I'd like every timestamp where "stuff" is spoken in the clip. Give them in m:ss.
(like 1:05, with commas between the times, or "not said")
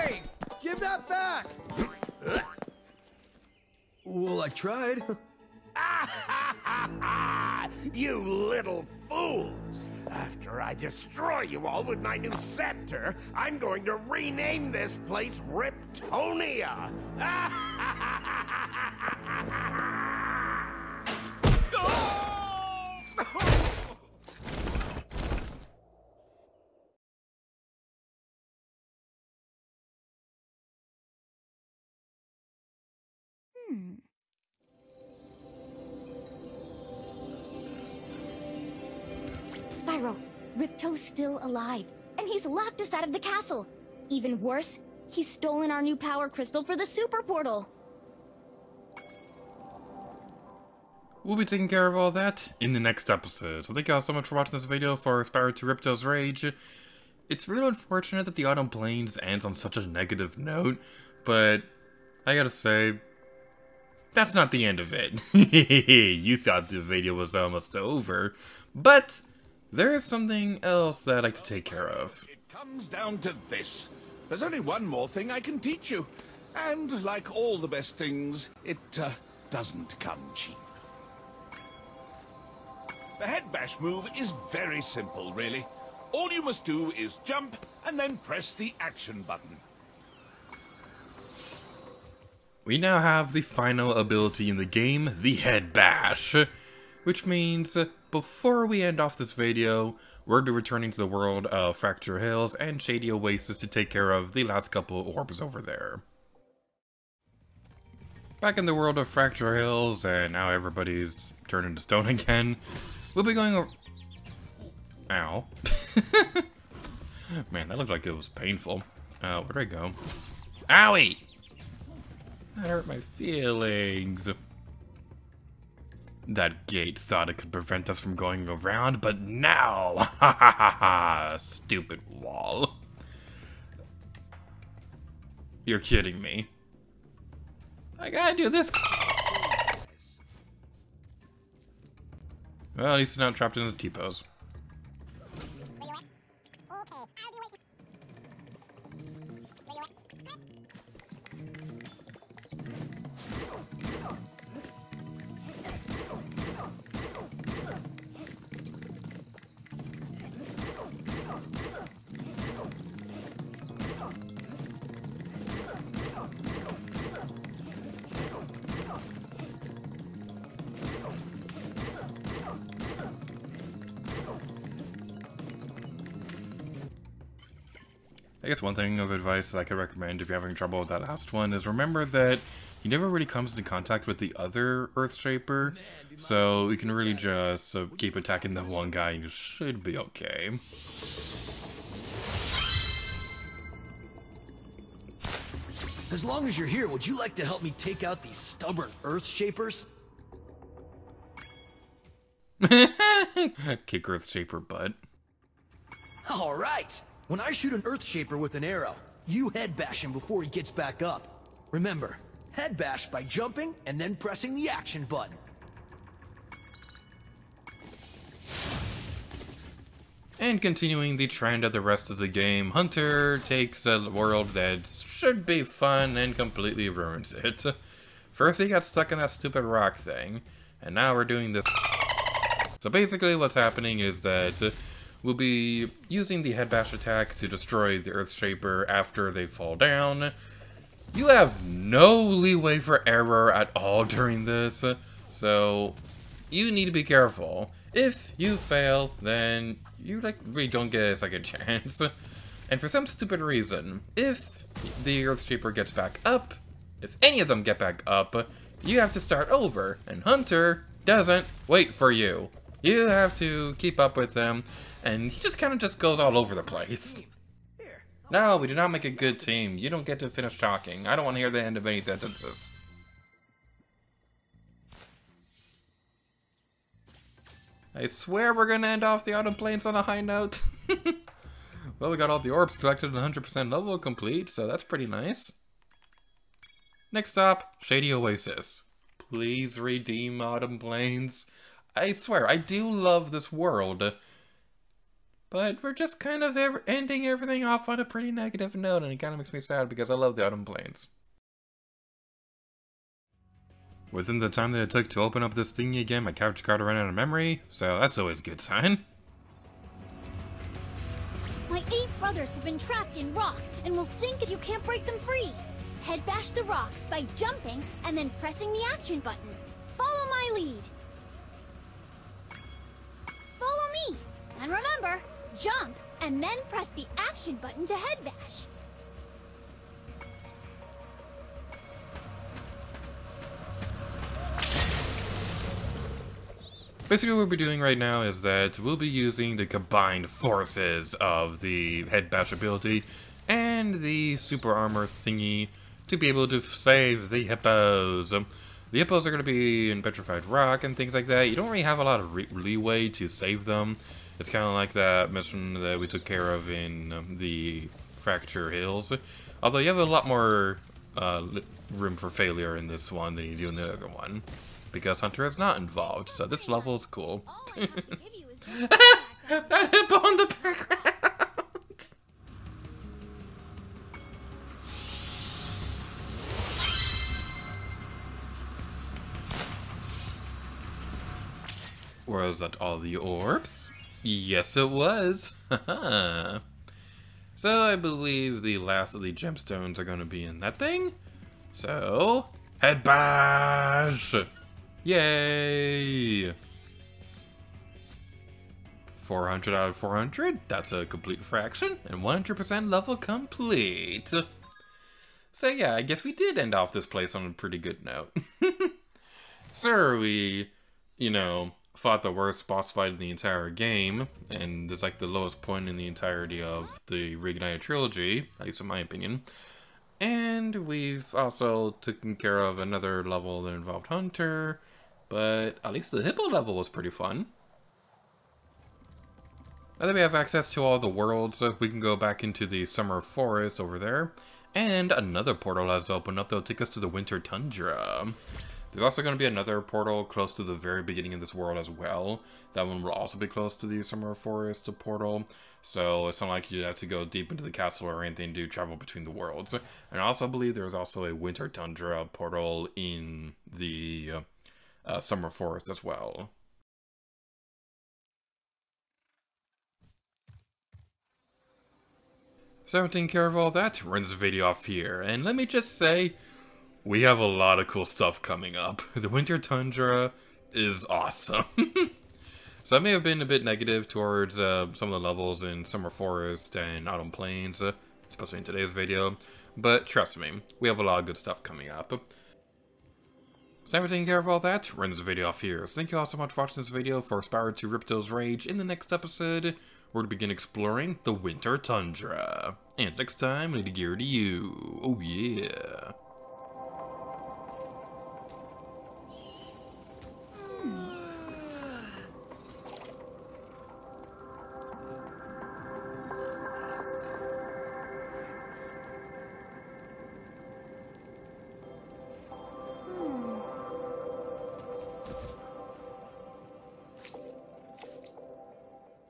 7:48, 8:01.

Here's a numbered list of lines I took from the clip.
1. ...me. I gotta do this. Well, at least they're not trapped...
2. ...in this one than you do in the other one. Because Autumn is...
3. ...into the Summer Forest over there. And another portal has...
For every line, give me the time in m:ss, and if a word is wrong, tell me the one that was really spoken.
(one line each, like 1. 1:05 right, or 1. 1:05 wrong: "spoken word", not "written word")
1. 2:16 right
2. 6:02 wrong: "Hunter", not "Autumn"
3. 7:12 right.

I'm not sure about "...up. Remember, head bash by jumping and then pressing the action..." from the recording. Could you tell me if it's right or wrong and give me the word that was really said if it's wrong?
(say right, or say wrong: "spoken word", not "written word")
right.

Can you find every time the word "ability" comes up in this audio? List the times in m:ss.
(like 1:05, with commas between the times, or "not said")
1:33, 5:42.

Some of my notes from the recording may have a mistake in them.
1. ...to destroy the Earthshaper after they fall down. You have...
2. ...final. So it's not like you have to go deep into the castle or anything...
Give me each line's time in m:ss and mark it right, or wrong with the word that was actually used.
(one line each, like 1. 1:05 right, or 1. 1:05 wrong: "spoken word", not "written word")
1. 3:57 right
2. 7:24 wrong: "portal", not "final".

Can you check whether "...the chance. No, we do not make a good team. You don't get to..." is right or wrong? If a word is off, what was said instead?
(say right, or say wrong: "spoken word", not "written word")
wrong: "place", not "chance".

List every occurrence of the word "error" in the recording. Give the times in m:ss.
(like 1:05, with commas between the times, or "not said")
4:03.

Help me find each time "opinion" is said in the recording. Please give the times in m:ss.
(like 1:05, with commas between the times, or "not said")
6:58.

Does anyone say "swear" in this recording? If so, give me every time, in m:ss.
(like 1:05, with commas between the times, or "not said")
4:38, 4:52.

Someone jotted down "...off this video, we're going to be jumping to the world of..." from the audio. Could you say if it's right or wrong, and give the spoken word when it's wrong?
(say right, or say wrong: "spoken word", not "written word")
wrong: "returning", not "jumping".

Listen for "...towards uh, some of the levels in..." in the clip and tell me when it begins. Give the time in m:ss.
7:54.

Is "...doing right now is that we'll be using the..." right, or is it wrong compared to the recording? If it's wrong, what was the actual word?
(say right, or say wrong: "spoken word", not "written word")
right.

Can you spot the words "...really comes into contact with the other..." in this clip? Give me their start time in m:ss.
3:03.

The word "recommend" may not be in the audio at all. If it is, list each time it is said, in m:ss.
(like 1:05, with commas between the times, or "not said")
2:59.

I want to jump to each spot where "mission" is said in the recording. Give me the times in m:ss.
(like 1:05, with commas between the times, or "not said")
5:55.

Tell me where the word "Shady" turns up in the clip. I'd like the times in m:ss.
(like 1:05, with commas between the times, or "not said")
1:42, 4:47.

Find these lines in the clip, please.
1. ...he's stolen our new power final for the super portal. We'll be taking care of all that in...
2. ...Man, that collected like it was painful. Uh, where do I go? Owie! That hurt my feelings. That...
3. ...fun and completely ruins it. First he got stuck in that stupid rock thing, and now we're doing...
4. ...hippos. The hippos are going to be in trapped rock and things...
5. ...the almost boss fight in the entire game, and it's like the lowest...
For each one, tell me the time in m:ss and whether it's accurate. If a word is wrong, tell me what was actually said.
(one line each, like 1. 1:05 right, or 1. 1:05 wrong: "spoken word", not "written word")
1. 0:45 wrong: "crystal", not "final"
2. 1:57 wrong: "looked", not "collected"
3. 3:45 right
4. 5:47 wrong: "petrified", not "trapped"
5. 6:52 wrong: "worst", not "almost".